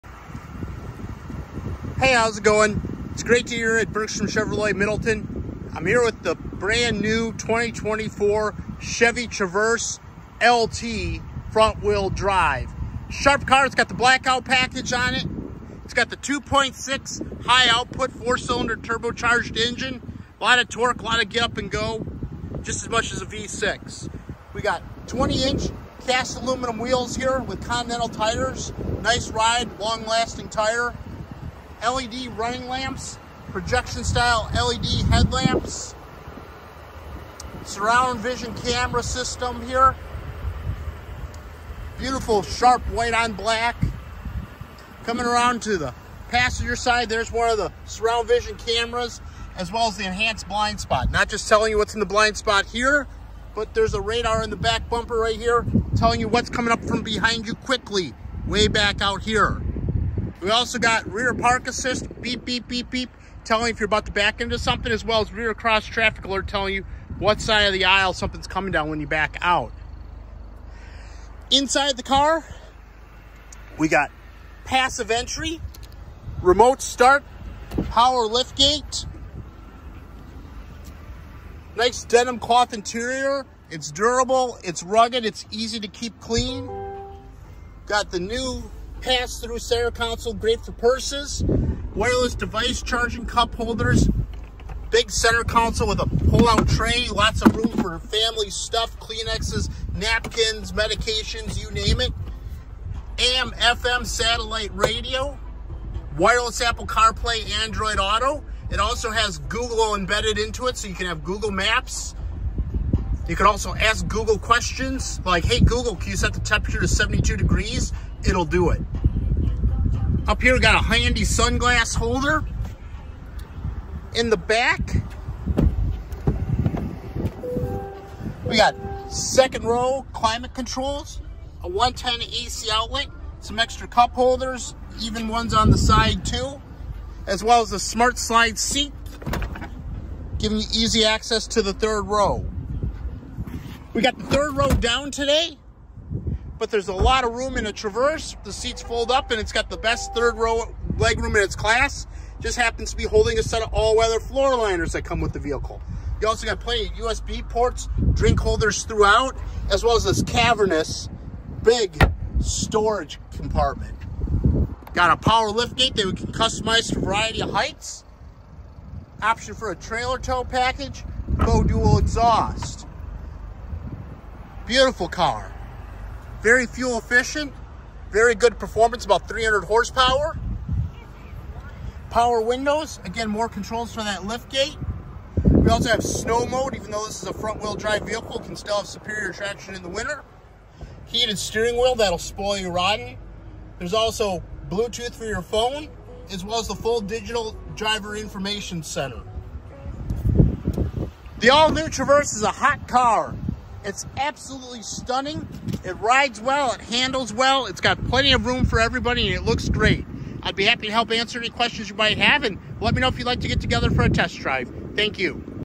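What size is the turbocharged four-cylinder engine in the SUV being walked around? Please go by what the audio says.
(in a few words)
2.6.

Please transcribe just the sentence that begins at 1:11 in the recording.
Inside the car, we got passive entry, remote start, power lift gate, nice denim cloth interior.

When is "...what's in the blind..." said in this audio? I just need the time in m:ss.
0:51.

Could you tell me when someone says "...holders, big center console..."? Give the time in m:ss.
1:33.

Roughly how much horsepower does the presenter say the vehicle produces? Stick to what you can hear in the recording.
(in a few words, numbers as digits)
about 300.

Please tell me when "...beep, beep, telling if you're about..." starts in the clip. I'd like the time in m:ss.
1:02.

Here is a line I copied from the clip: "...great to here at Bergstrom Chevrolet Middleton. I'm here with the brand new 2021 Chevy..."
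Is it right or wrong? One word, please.
wrong.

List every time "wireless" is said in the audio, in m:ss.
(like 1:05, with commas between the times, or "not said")
1:31, 1:46.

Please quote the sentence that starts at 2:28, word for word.
The seats fold up and it's got the best third row leg room in its class.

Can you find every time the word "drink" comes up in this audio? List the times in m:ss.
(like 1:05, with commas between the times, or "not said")
2:38.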